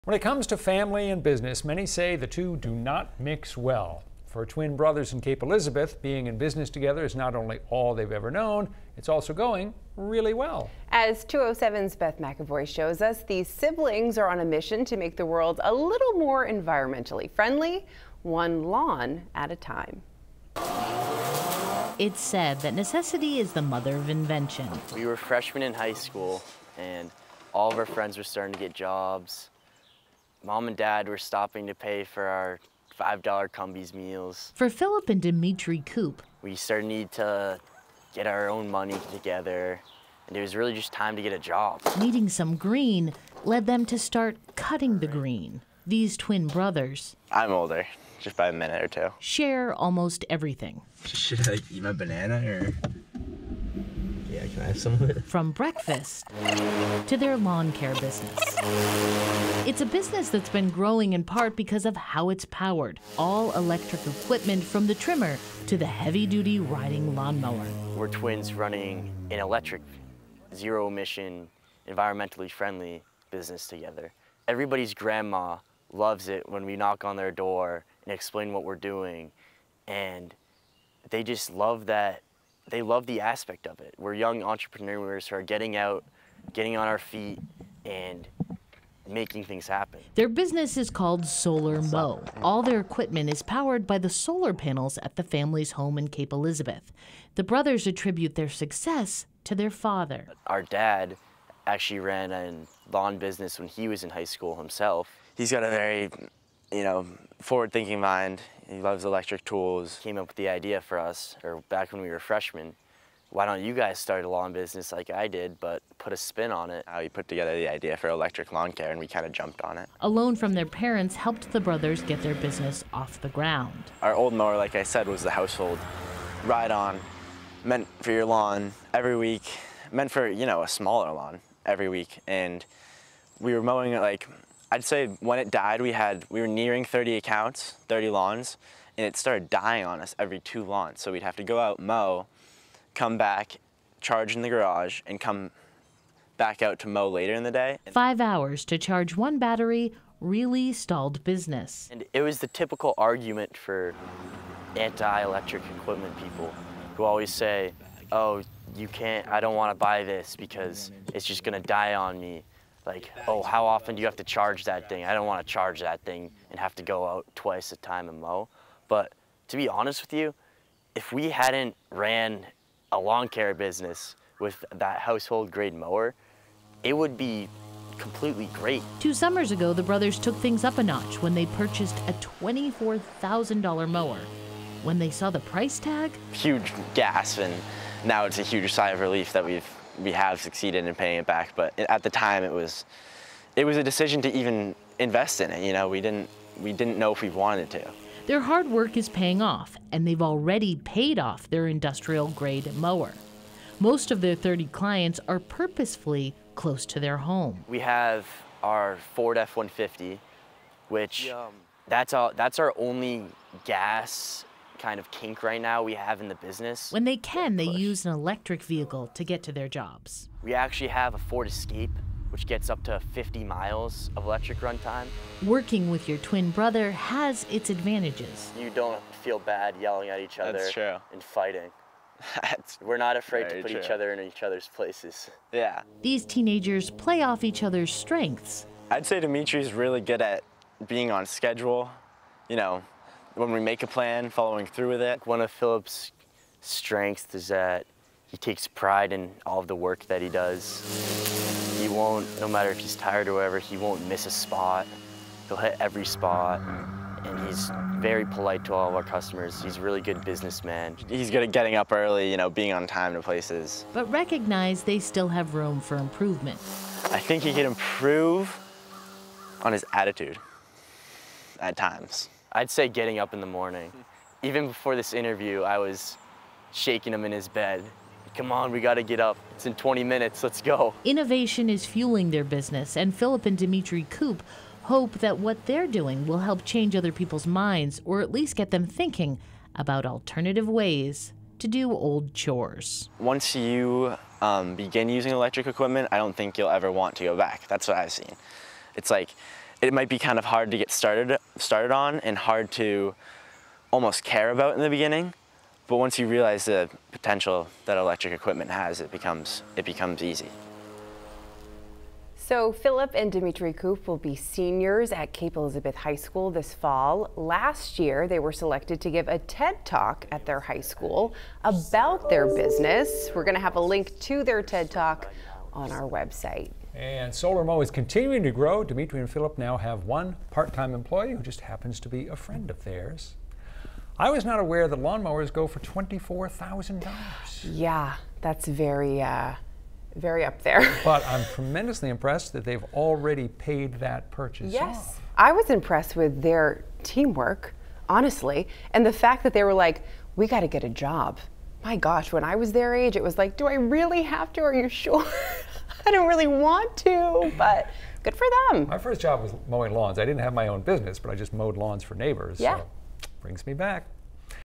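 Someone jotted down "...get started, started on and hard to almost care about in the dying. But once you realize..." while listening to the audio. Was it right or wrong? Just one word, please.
wrong.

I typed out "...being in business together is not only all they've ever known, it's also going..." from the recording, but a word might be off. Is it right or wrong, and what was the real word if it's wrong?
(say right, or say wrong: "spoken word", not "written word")
right.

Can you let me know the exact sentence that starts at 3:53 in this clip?
each other in each other's places.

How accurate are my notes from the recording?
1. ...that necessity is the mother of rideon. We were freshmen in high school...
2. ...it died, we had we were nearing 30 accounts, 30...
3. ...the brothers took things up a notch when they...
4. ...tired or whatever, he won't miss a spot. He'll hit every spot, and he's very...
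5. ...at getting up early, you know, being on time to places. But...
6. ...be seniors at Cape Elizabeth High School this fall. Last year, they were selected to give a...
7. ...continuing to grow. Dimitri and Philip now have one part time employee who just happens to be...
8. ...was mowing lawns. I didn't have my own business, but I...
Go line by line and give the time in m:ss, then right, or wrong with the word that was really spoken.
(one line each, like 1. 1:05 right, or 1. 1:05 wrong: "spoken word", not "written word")
1. 0:22 wrong: "invention", not "rideon"
2. 2:15 right
3. 2:59 right
4. 4:12 right
5. 4:21 right
6. 5:14 right
7. 5:27 right
8. 5:59 right.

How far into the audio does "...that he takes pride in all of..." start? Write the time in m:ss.
4:07.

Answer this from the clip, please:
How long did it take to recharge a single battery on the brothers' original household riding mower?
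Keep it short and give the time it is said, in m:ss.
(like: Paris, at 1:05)
5 hours, at 2:27.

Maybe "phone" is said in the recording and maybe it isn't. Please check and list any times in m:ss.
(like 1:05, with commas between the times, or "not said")
not said.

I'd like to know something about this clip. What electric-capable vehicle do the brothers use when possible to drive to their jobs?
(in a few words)
Ford Escape.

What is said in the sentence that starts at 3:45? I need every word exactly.
Working with your twin brother has its advantages.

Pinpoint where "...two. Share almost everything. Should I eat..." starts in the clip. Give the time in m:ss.
0:48.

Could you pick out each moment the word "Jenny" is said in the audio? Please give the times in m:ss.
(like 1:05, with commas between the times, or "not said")
not said.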